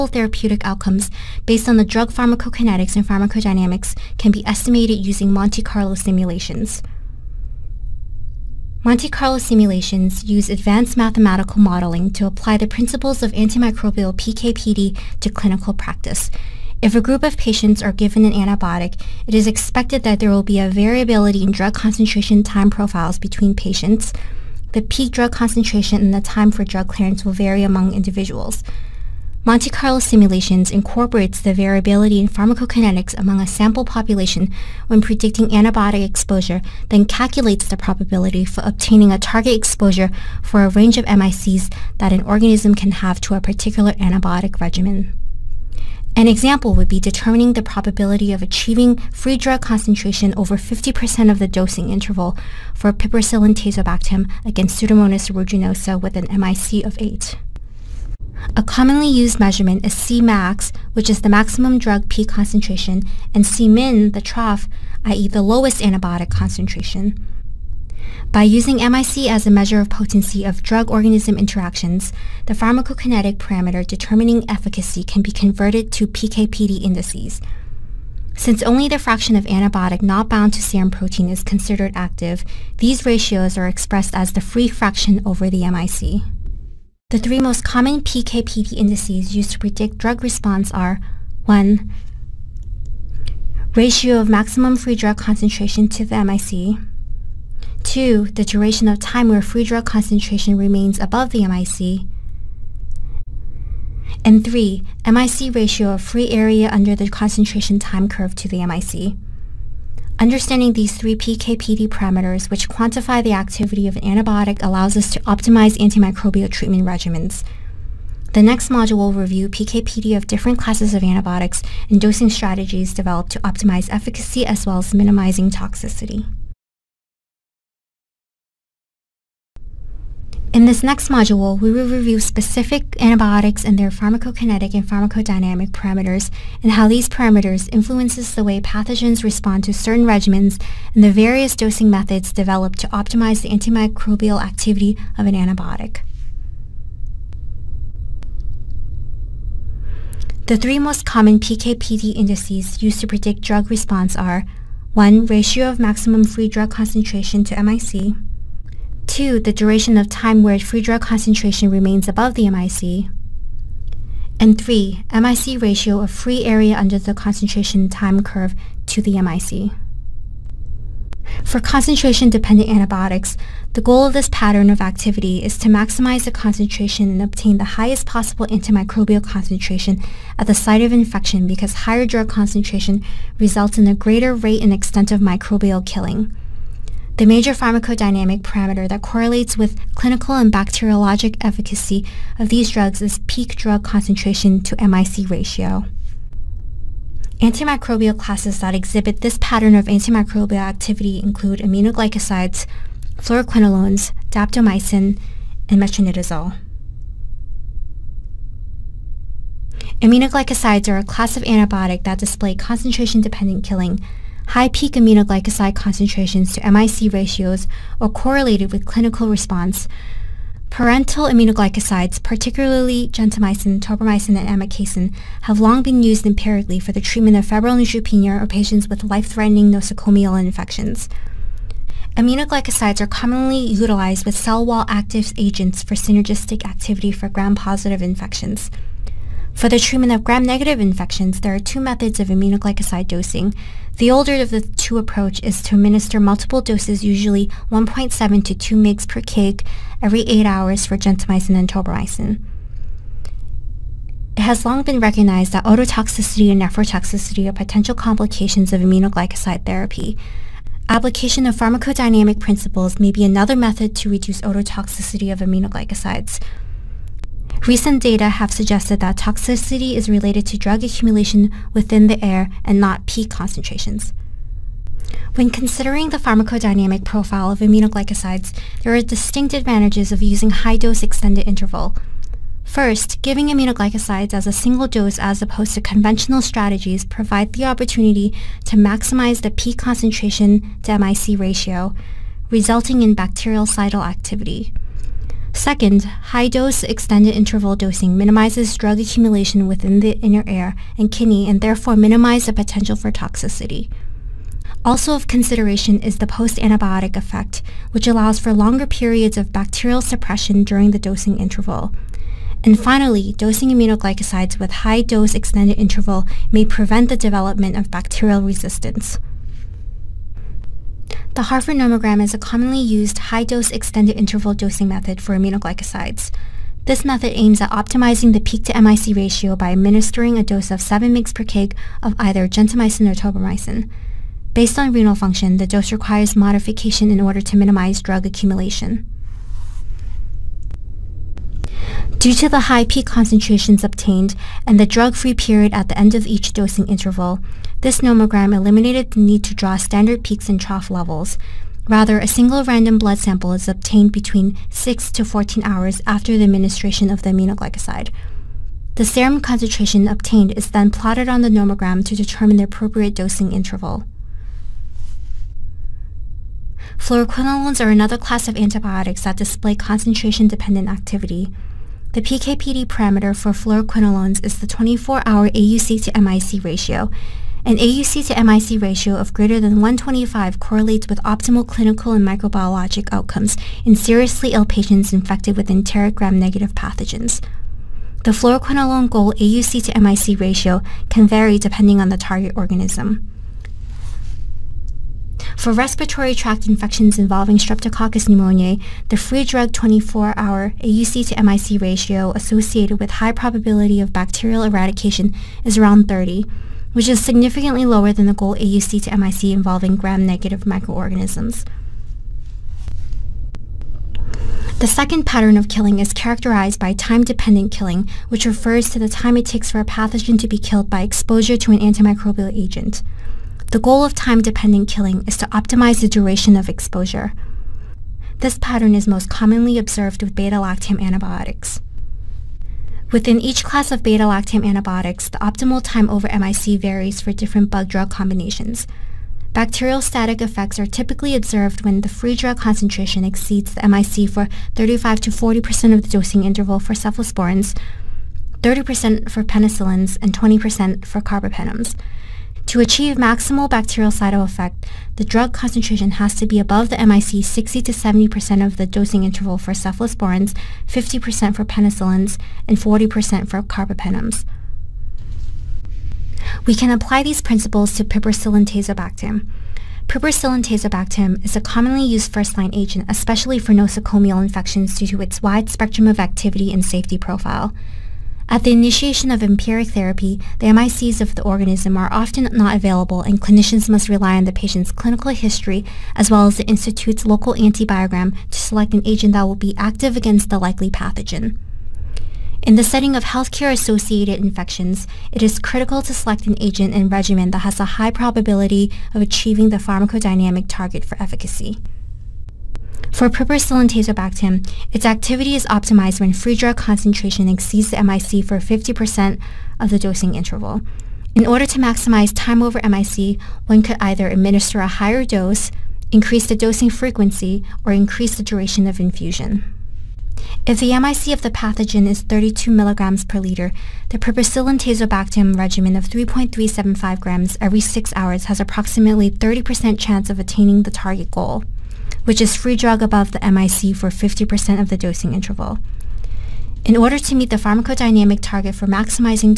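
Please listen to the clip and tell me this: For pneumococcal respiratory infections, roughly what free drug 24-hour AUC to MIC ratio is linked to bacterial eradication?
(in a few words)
around 30.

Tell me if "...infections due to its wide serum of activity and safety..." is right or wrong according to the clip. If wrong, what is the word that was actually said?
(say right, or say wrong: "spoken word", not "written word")
wrong: "spectrum", not "serum".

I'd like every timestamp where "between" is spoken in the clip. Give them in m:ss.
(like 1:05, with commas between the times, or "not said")
0:23, 5:54.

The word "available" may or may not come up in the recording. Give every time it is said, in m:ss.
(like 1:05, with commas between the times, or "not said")
8:02.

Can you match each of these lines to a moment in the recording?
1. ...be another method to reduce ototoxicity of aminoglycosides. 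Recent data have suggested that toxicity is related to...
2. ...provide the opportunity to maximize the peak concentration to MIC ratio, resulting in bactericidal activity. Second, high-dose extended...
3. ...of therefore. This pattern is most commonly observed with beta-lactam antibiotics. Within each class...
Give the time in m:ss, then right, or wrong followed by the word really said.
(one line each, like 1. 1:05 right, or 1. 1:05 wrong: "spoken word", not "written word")
1. 4:23 right
2. 4:47 right
3. 7:06 wrong: "exposure", not "therefore".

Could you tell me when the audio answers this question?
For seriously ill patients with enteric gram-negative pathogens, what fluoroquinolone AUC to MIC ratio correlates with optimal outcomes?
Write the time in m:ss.
6:19.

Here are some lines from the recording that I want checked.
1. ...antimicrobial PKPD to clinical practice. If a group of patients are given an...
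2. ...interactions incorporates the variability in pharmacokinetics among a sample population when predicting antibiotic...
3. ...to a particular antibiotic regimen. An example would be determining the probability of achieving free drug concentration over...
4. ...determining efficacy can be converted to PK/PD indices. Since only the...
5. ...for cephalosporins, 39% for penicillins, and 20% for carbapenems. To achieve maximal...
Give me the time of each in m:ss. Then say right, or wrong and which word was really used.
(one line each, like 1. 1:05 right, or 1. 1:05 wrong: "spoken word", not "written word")
1. 0:13 right
2. 0:29 wrong: "simulations", not "interactions"
3. 0:43 right
4. 1:13 right
5. 7:26 wrong: "30", not "39".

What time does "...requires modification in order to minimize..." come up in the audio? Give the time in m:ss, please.
5:35.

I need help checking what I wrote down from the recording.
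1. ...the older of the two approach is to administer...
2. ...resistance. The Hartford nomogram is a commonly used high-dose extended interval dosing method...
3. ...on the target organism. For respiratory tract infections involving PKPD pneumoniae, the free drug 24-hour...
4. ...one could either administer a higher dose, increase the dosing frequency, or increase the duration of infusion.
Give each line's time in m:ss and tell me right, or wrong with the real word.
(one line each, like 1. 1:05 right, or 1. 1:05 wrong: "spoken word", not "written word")
1. 4:03 right
2. 5:18 right
3. 6:32 wrong: "Streptococcus", not "PKPD"
4. 8:33 right.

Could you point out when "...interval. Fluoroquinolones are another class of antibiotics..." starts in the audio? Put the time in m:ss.
6:03.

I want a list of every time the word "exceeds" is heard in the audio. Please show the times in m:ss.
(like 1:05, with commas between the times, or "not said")
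7:23, 8:27.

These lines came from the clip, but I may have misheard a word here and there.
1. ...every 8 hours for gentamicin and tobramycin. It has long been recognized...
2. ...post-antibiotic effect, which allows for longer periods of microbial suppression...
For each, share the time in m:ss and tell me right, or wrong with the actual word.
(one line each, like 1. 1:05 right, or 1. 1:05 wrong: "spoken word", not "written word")
1. 4:10 right
2. 5:06 wrong: "bacterial", not "microbial".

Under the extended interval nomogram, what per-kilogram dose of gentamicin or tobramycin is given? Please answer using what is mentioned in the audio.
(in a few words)
7 mg per kg.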